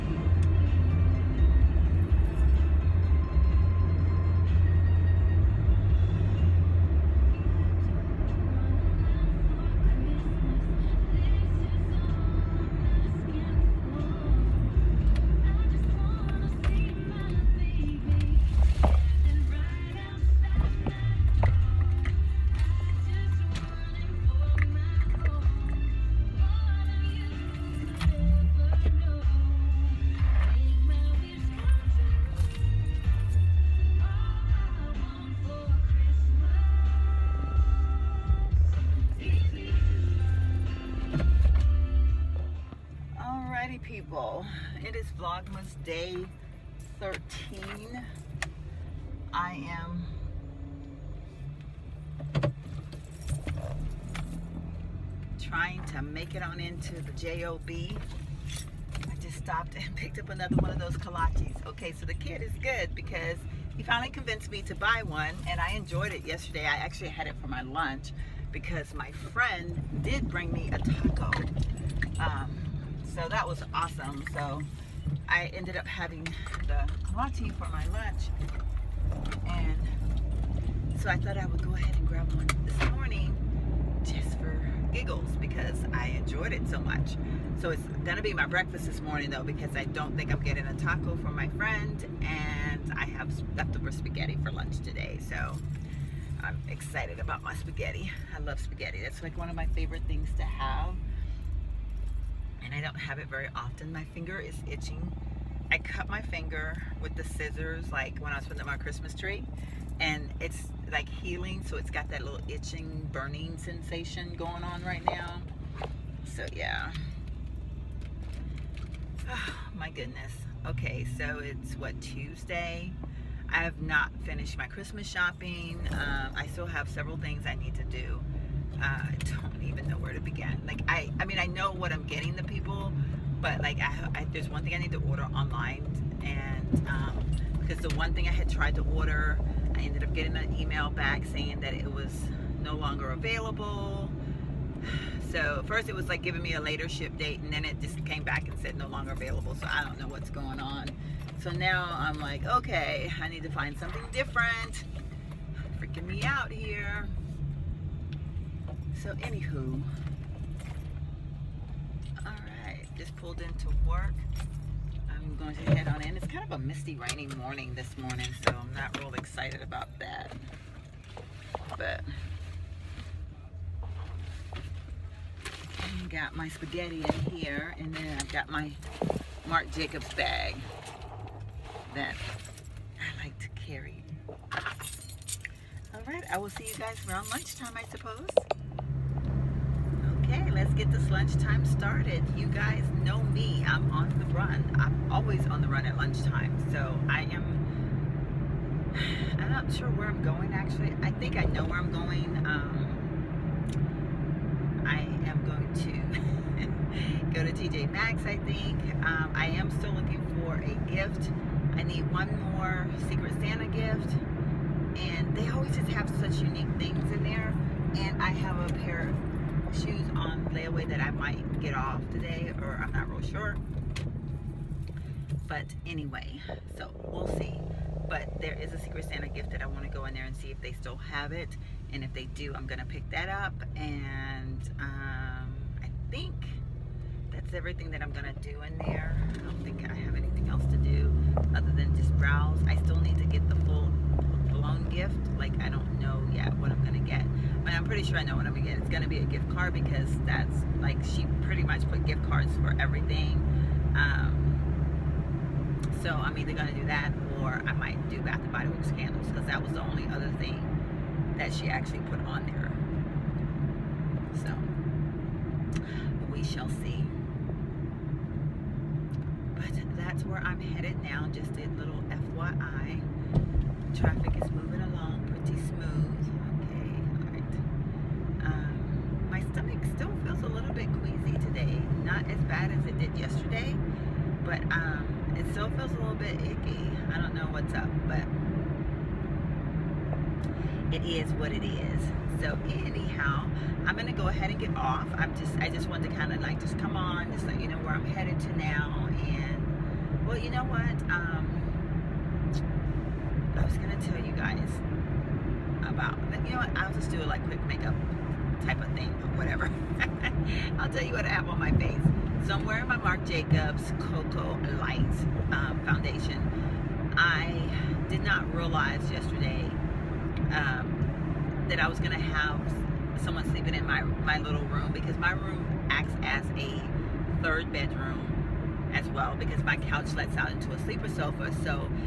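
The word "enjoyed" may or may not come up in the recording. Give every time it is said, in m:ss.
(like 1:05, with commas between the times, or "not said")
1:05, 1:26.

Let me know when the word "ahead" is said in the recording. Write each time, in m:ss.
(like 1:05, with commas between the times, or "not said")
1:21, 4:54.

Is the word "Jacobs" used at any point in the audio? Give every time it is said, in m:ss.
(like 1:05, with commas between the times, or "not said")
2:59, 5:13.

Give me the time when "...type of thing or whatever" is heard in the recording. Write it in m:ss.
5:08.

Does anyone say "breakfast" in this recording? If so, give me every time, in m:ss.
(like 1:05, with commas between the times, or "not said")
1:28.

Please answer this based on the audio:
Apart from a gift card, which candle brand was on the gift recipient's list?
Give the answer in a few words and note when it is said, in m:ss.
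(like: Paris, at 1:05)
Bath and Body Works, at 4:18.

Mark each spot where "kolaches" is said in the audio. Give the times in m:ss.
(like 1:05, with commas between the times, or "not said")
1:00, 1:17.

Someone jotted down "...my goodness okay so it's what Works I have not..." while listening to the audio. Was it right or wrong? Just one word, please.
wrong.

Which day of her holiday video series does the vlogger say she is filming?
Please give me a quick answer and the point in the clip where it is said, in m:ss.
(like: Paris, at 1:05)
Day 13, at 0:45.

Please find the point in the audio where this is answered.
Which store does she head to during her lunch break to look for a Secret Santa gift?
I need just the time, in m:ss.
3:27.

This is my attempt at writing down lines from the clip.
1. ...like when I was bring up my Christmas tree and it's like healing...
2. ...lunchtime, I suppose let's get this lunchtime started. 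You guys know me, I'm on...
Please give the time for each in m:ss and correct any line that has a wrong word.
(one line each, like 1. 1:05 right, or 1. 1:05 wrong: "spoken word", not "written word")
1. 1:47 wrong: "putting", not "bring"
2. 3:07 right.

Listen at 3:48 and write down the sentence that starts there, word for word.
But there is a Secret Santa gift that I want to go in there and see if they still have it.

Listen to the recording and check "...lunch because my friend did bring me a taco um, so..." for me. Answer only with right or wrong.
right.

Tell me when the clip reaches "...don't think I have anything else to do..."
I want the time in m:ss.
3:59.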